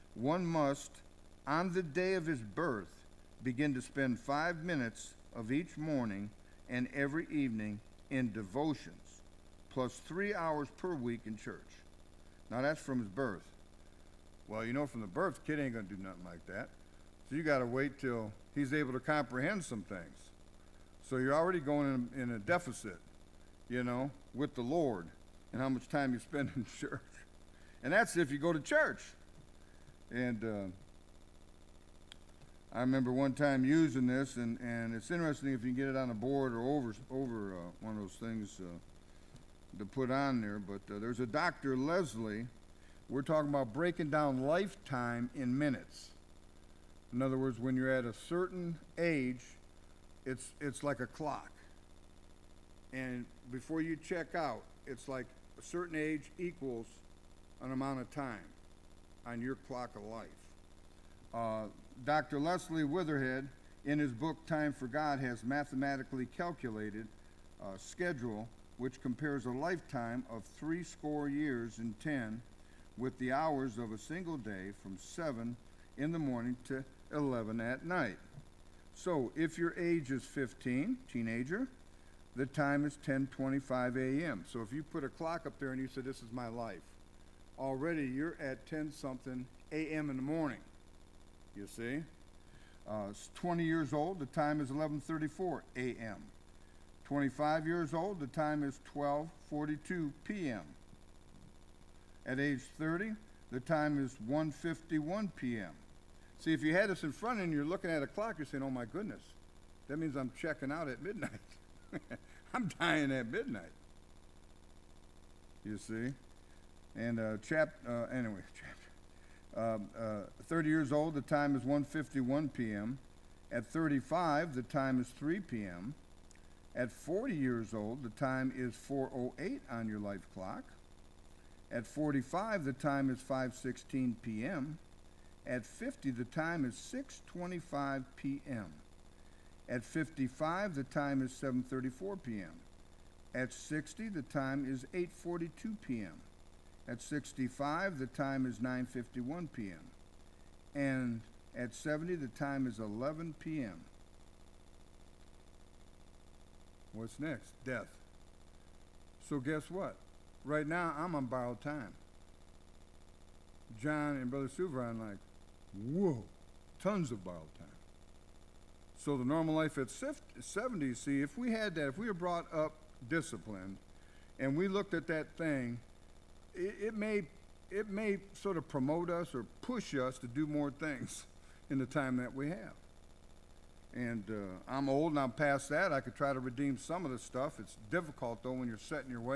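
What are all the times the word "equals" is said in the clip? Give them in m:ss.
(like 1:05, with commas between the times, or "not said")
0:56.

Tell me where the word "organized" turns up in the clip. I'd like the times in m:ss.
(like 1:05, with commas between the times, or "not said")
not said.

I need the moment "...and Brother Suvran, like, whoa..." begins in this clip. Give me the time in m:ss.
2:44.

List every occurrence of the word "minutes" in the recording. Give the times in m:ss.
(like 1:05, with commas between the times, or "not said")
0:04, 0:45.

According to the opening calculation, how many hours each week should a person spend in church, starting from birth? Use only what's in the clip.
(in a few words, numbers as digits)
3 hours.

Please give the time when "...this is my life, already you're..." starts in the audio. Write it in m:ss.
1:25.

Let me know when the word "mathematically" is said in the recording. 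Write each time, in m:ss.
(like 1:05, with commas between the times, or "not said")
1:05.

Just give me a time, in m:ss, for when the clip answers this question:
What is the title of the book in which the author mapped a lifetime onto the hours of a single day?
1:04.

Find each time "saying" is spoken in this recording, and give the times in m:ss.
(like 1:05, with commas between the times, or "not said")
1:48.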